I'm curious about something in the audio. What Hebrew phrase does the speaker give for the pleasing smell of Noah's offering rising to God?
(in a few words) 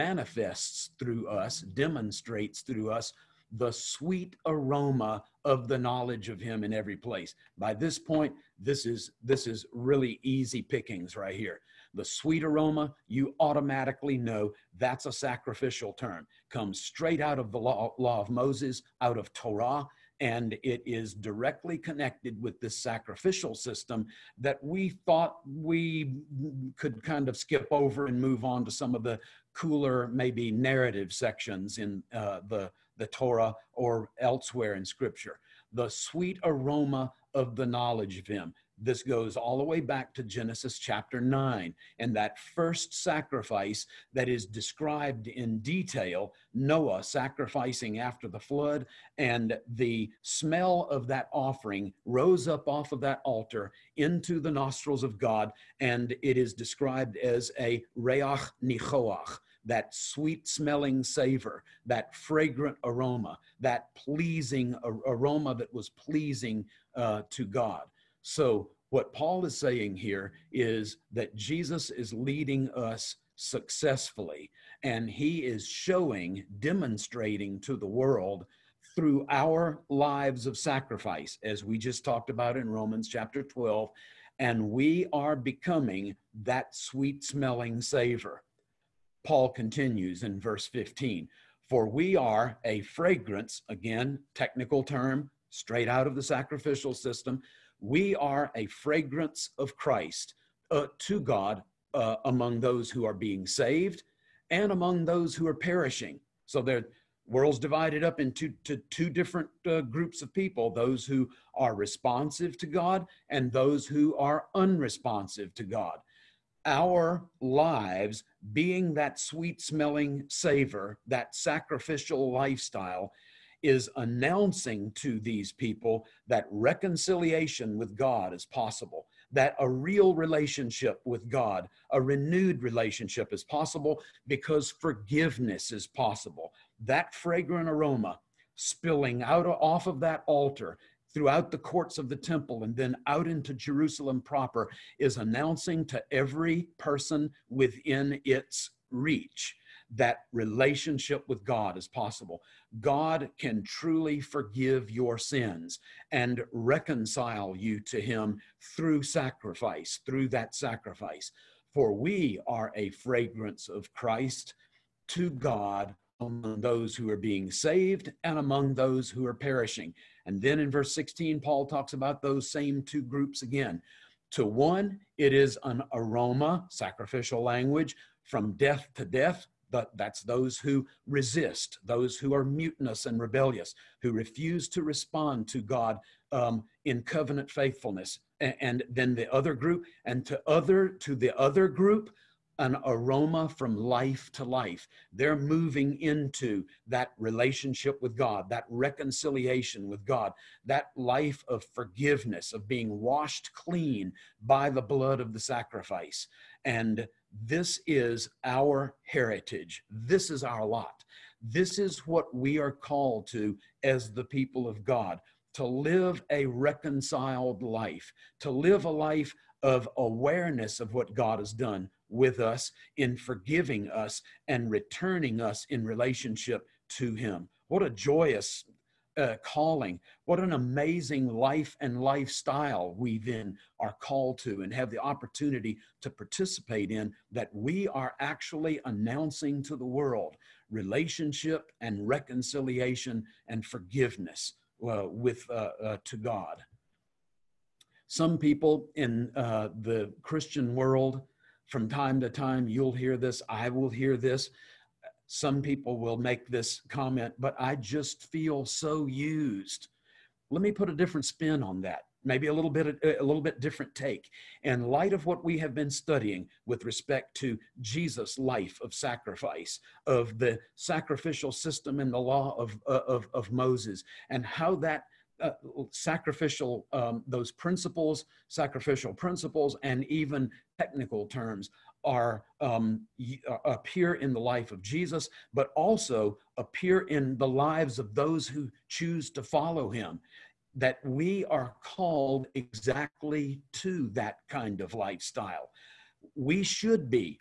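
reiach nichoach.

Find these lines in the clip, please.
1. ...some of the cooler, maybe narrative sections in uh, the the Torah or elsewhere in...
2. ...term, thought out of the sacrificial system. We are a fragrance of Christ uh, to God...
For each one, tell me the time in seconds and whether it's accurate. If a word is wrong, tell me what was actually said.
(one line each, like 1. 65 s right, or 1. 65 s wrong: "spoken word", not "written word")
1. 28 s right
2. 94 s wrong: "straight", not "thought".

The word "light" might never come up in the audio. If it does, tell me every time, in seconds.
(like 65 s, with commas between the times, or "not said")
264 s.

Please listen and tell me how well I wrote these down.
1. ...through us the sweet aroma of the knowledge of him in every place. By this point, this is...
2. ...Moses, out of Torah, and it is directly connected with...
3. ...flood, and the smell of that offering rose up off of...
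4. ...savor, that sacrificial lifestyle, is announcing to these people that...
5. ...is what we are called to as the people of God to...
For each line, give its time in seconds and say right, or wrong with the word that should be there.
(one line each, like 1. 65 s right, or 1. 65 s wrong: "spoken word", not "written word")
1. 2 s right
2. 18 s right
3. 48 s right
4. 120 s right
5. 211 s right.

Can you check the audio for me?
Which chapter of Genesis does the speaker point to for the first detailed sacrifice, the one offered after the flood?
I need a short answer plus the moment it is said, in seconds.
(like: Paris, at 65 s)
Chapter 9, at 40 s.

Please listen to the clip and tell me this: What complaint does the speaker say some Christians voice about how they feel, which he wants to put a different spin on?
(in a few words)
I just feel so used.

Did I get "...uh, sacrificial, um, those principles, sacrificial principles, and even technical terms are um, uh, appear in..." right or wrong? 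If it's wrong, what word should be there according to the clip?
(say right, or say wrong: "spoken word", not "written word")
right.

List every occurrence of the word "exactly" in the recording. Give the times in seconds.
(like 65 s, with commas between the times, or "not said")
292 s.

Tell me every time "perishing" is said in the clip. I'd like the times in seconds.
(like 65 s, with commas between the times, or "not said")
105 s, 169 s.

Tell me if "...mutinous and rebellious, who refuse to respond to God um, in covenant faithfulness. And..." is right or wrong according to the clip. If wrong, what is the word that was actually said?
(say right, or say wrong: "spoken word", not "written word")
right.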